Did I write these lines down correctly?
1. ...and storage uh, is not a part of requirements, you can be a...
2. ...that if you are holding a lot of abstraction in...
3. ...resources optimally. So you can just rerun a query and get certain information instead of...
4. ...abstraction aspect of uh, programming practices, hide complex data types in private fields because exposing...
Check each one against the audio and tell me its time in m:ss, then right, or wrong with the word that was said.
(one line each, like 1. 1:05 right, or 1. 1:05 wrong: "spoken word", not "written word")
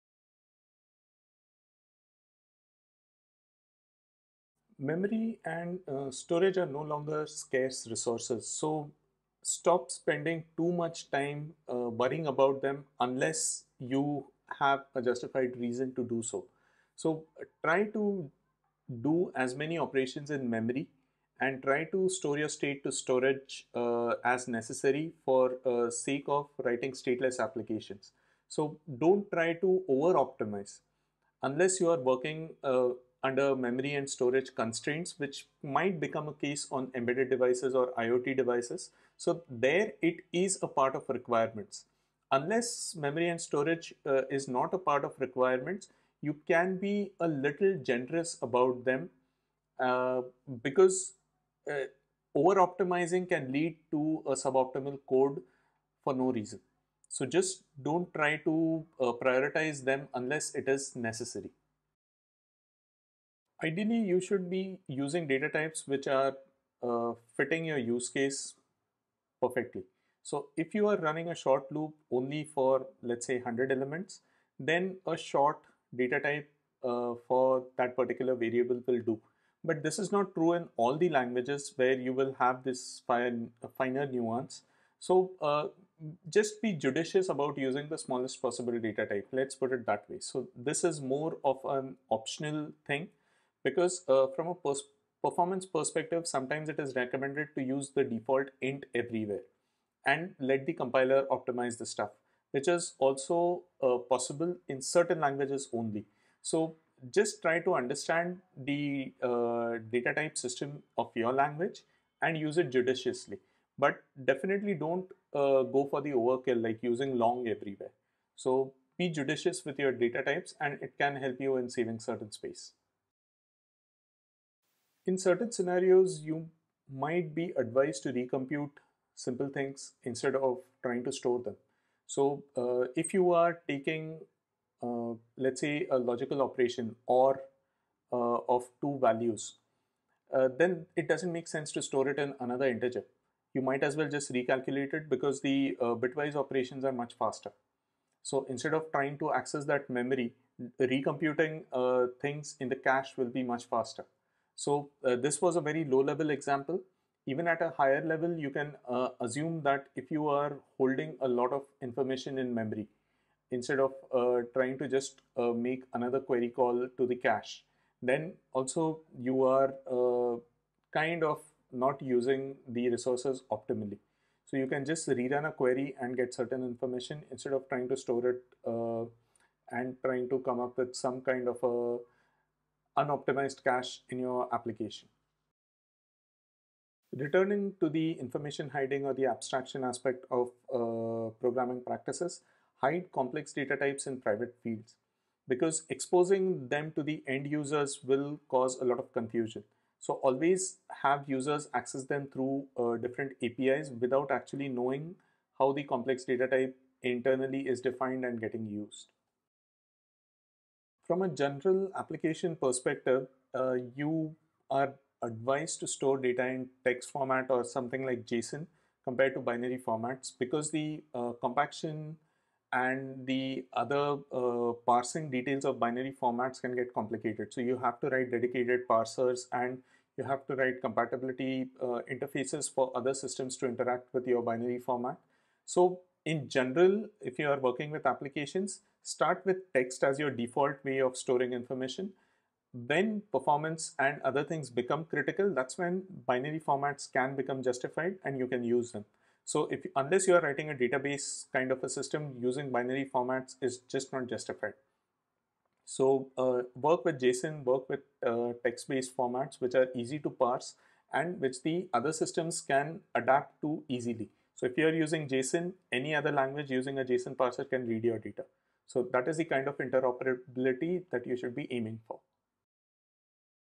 1. 0:43 right
2. 2:39 wrong: "information", not "abstraction"
3. 2:52 right
4. 3:09 right.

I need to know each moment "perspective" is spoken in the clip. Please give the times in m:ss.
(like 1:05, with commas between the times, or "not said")
1:35, 3:32.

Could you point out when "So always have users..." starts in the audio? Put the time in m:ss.
3:19.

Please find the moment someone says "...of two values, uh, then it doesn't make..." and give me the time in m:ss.
2:18.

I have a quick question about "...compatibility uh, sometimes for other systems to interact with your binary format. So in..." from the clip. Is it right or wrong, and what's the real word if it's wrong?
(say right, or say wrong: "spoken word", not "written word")
wrong: "interfaces", not "sometimes".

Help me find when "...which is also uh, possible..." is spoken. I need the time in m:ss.
1:42.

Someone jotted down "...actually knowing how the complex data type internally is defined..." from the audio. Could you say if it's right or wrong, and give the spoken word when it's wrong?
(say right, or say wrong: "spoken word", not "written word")
right.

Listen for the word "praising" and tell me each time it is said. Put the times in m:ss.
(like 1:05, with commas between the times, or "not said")
not said.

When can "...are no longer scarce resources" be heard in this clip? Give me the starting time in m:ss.
0:06.